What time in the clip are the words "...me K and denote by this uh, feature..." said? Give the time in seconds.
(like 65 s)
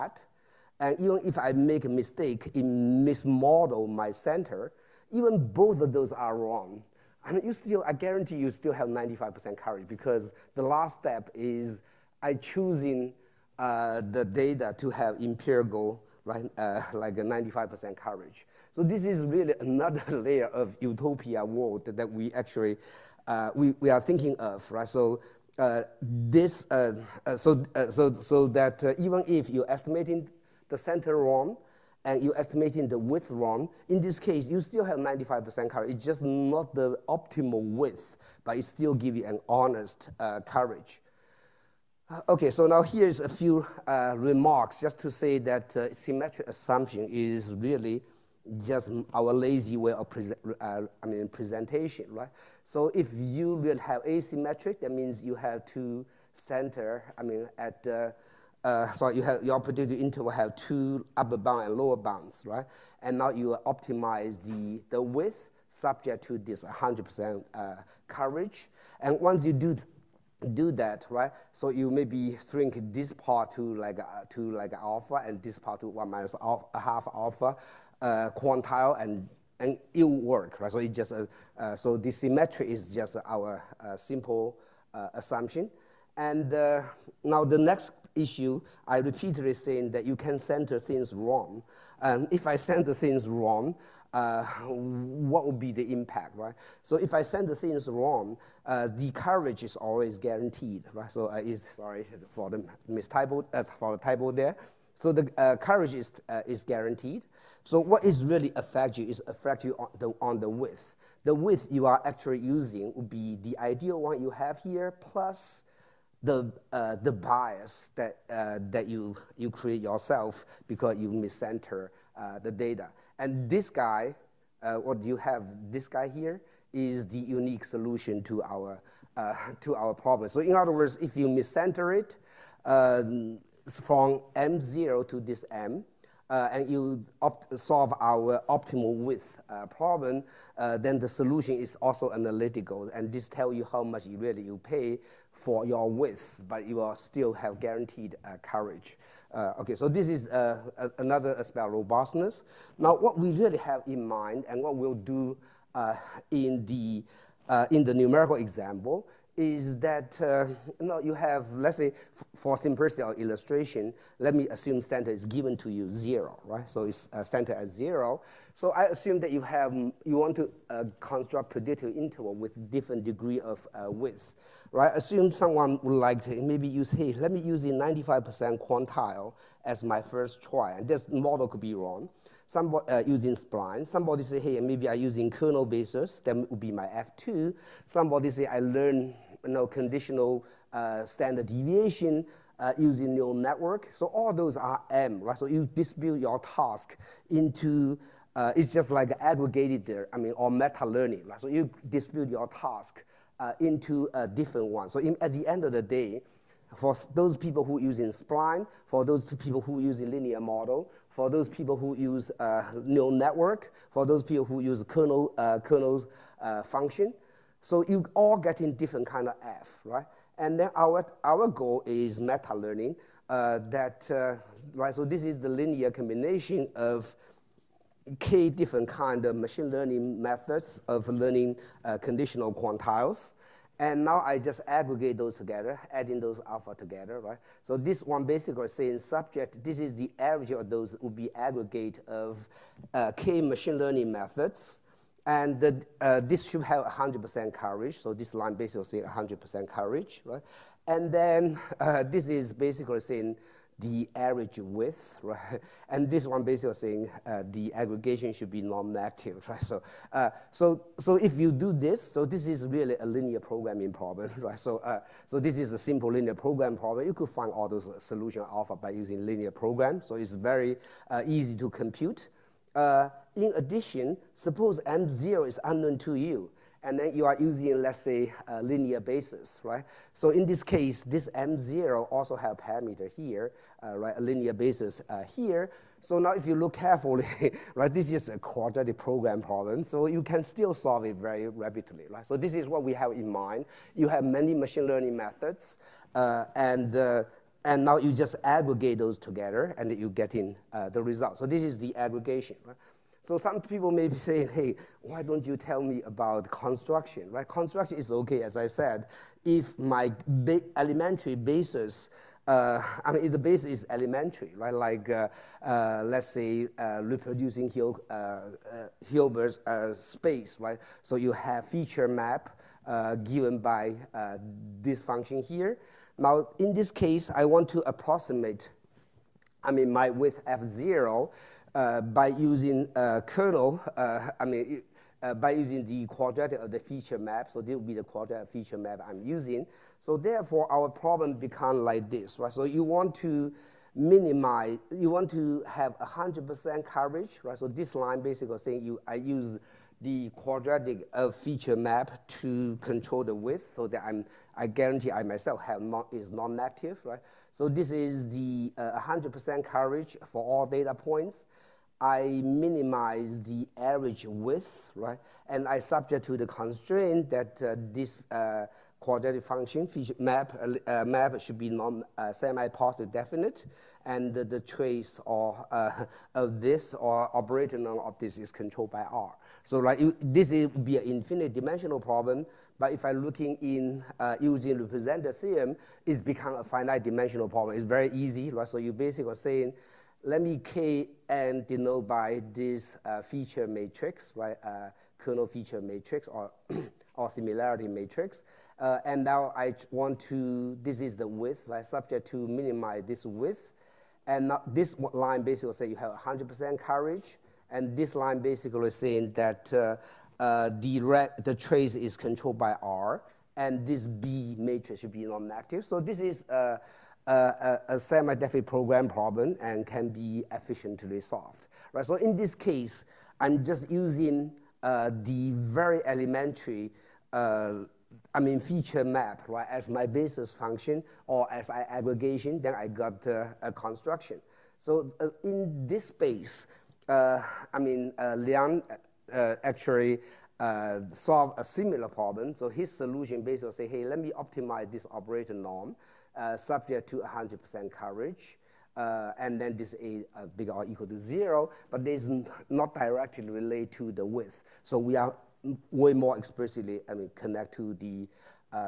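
390 s.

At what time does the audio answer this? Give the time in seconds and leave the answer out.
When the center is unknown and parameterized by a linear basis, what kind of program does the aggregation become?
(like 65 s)
288 s.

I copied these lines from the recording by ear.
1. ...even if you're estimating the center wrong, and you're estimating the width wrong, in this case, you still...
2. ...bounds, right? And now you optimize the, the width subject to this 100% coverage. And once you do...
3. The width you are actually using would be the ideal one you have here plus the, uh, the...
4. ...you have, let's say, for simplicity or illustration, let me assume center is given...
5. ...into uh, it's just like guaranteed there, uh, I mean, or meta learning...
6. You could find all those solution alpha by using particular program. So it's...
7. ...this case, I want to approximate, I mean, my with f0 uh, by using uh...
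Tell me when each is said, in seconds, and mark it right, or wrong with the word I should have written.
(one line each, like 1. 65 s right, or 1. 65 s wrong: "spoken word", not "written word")
1. 28 s right
2. 61 s right
3. 111 s right
4. 161 s right
5. 197 s wrong: "aggregated", not "guaranteed"
6. 267 s wrong: "linear", not "particular"
7. 326 s right.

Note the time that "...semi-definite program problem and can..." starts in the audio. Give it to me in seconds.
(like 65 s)
417 s.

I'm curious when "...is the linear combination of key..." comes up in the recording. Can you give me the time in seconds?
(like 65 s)
225 s.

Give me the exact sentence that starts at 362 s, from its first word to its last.
I minimize the average width, right?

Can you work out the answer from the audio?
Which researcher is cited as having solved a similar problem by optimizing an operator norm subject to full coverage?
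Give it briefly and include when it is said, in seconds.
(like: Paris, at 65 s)
Liang, at 438 s.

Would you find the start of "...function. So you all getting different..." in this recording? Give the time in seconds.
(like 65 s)
216 s.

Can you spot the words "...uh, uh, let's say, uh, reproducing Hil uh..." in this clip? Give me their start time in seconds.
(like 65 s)
315 s.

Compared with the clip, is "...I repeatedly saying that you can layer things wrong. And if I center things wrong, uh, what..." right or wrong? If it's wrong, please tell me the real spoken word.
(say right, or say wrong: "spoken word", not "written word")
wrong: "center", not "layer".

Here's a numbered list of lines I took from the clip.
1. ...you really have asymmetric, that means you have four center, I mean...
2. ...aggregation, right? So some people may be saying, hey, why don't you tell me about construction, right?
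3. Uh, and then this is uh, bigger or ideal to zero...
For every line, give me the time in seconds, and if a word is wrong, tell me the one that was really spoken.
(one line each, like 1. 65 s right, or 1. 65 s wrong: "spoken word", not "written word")
1. 53 s wrong: "two", not "four"
2. 301 s right
3. 448 s wrong: "equal", not "ideal".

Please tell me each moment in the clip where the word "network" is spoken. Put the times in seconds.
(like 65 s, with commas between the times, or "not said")
193 s, 213 s.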